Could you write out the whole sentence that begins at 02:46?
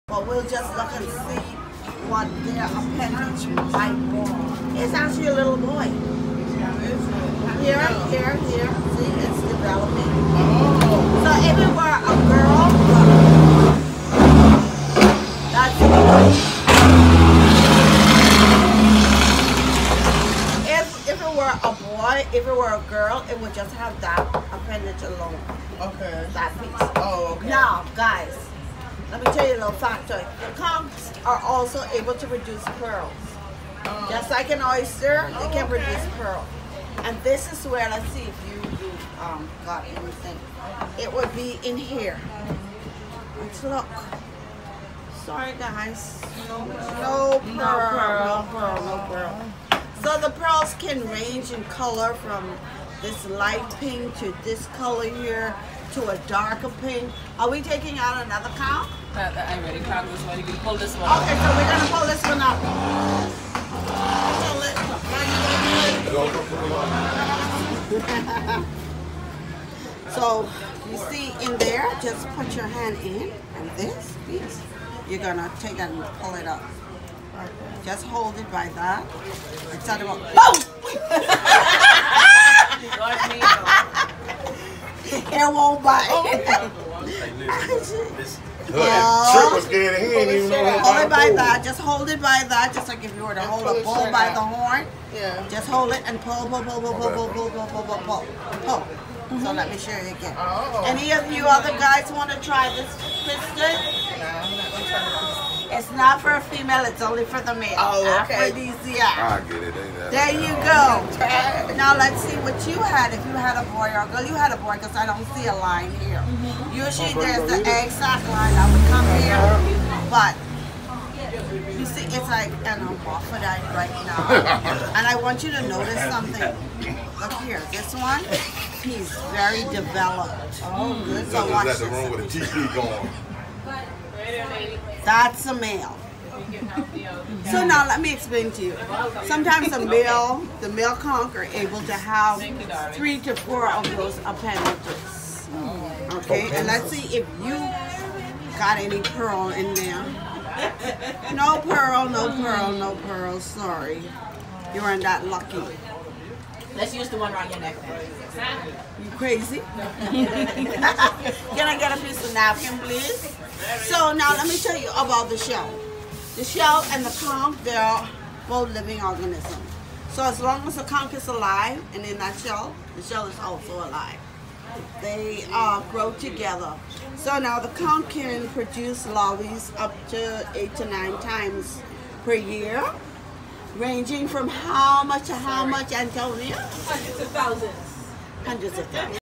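The shell and the conch, they're both living organisms.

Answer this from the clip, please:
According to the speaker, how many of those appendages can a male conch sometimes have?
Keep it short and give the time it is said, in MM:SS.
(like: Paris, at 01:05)
3 to 4, at 02:22.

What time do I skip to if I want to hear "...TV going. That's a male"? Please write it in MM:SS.
02:12.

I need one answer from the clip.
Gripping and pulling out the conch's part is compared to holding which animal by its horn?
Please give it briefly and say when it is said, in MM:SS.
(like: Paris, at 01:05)
bull, at 01:33.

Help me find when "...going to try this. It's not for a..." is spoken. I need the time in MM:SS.
01:44.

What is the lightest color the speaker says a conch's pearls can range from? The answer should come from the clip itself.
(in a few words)
light pink.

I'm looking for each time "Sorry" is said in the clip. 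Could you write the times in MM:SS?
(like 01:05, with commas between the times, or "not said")
00:45, 02:33.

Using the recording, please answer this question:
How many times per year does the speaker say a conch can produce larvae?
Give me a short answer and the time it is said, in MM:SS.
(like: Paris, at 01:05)
8 to 9, at 03:00.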